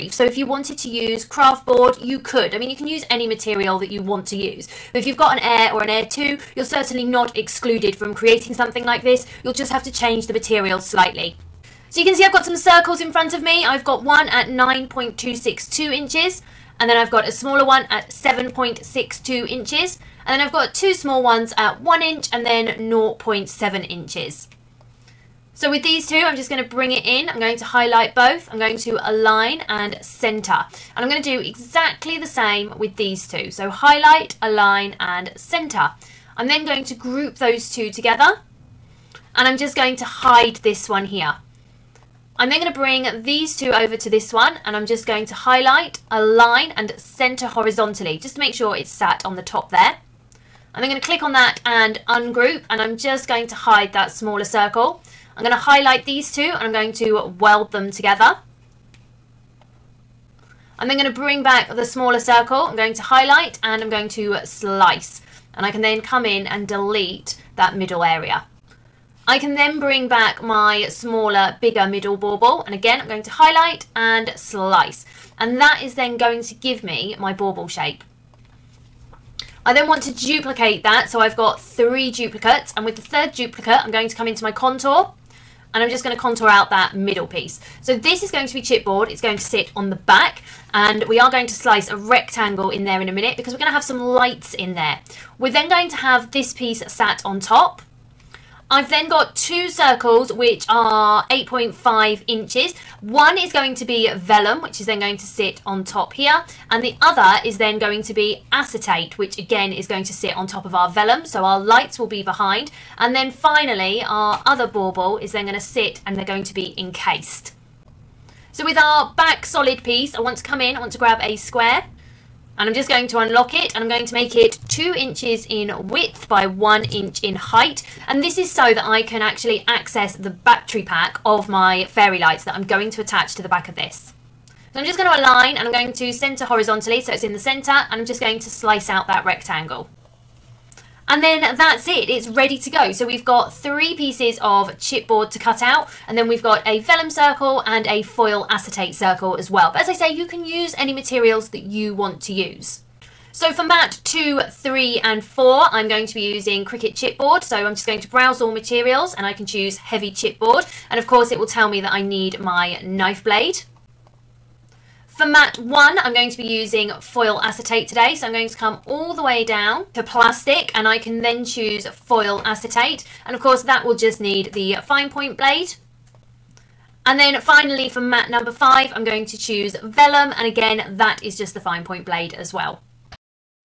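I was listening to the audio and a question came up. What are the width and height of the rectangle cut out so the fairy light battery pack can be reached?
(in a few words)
2 inches by 1 inch.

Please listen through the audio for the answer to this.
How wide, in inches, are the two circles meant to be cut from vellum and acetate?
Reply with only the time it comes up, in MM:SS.
01:41.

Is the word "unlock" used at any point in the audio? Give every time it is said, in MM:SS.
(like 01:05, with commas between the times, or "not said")
02:03.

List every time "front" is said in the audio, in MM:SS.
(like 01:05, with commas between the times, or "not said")
00:13.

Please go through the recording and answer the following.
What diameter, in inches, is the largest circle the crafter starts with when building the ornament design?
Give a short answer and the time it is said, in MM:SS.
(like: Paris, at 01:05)
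9.262 inches, at 00:14.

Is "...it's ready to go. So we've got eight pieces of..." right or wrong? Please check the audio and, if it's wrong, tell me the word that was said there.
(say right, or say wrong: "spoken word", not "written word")
wrong: "three", not "eight".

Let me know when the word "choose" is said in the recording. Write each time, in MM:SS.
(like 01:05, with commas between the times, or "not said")
02:39, 02:51, 02:59.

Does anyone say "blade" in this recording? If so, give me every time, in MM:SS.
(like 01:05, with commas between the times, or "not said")
02:43, 02:55, 03:02.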